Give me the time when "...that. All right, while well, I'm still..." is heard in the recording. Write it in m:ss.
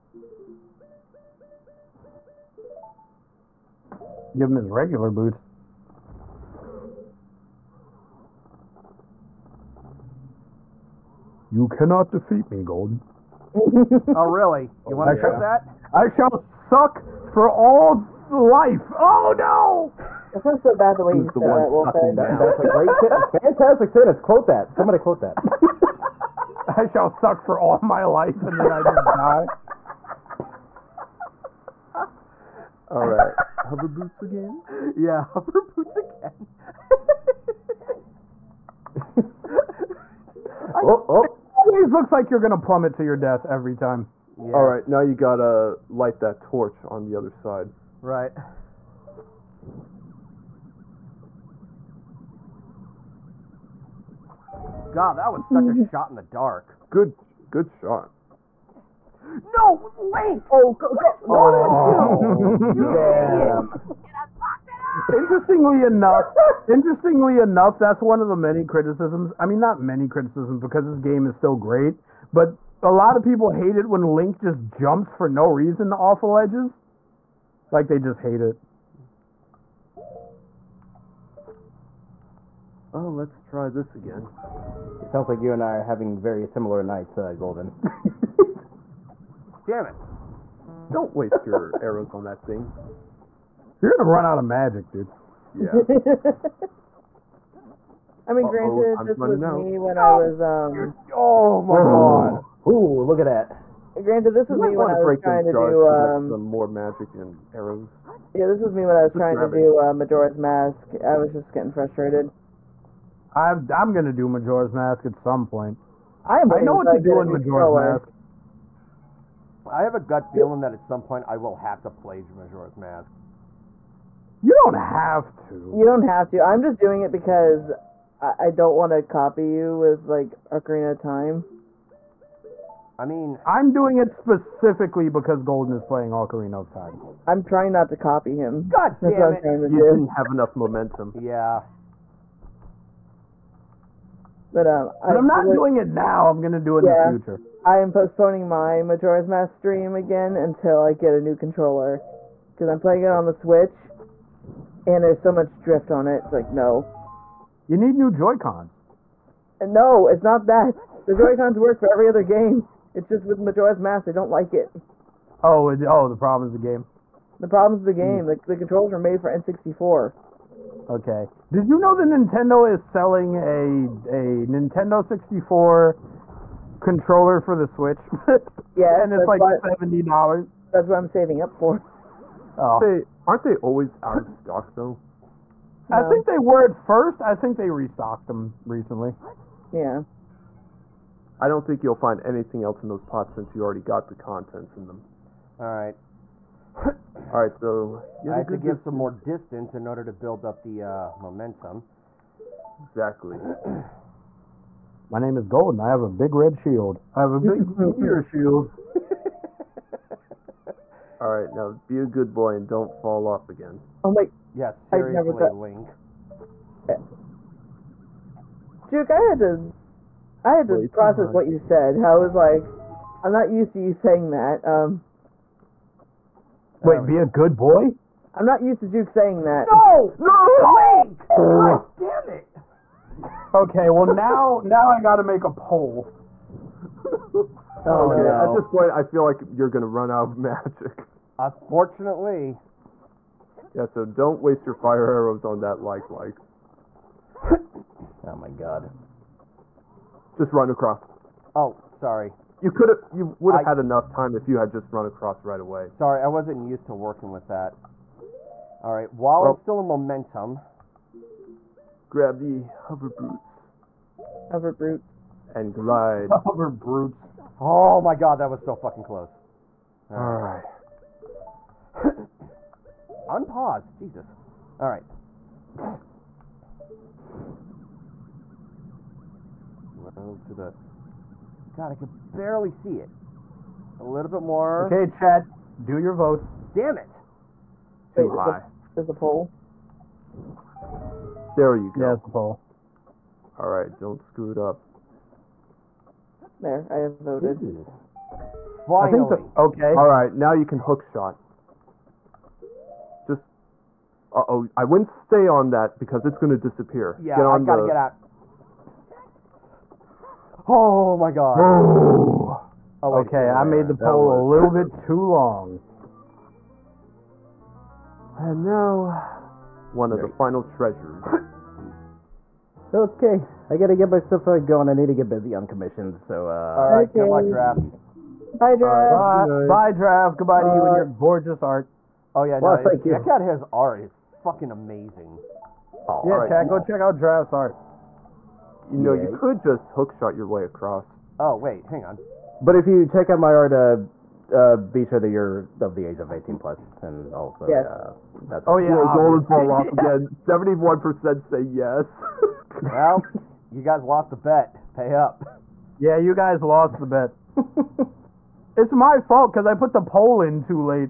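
4:17.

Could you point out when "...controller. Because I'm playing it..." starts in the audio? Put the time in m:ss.
2:31.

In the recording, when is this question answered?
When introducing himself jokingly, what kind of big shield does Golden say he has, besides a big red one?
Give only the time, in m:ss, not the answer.
3:27.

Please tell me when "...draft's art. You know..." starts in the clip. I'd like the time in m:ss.
5:37.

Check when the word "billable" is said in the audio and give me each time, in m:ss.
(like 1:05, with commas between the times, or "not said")
not said.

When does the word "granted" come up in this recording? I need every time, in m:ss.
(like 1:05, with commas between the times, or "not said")
1:38, 1:43.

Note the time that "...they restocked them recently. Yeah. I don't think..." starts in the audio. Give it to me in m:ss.
3:07.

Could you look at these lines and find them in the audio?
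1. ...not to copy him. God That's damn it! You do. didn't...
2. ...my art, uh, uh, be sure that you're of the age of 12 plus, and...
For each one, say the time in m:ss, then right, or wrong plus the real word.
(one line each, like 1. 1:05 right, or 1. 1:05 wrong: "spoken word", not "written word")
1. 2:17 right
2. 5:43 wrong: "18", not "12".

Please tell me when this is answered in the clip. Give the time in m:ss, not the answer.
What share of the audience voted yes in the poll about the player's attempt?
5:50.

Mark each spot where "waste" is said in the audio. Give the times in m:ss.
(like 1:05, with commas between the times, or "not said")
1:31, 4:04.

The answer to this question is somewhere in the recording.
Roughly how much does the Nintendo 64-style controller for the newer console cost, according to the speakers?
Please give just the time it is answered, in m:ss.
2:59.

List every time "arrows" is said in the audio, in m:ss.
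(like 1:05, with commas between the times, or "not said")
1:31, 1:47, 4:05.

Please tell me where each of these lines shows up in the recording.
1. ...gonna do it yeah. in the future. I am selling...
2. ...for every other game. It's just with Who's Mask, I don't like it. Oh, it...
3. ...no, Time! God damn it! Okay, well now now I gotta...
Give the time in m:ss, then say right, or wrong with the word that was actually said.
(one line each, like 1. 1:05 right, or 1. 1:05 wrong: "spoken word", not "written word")
1. 2:26 wrong: "postponing", not "selling"
2. 2:41 wrong: "Majora", not "Who"
3. 3:50 wrong: "Link", not "Time".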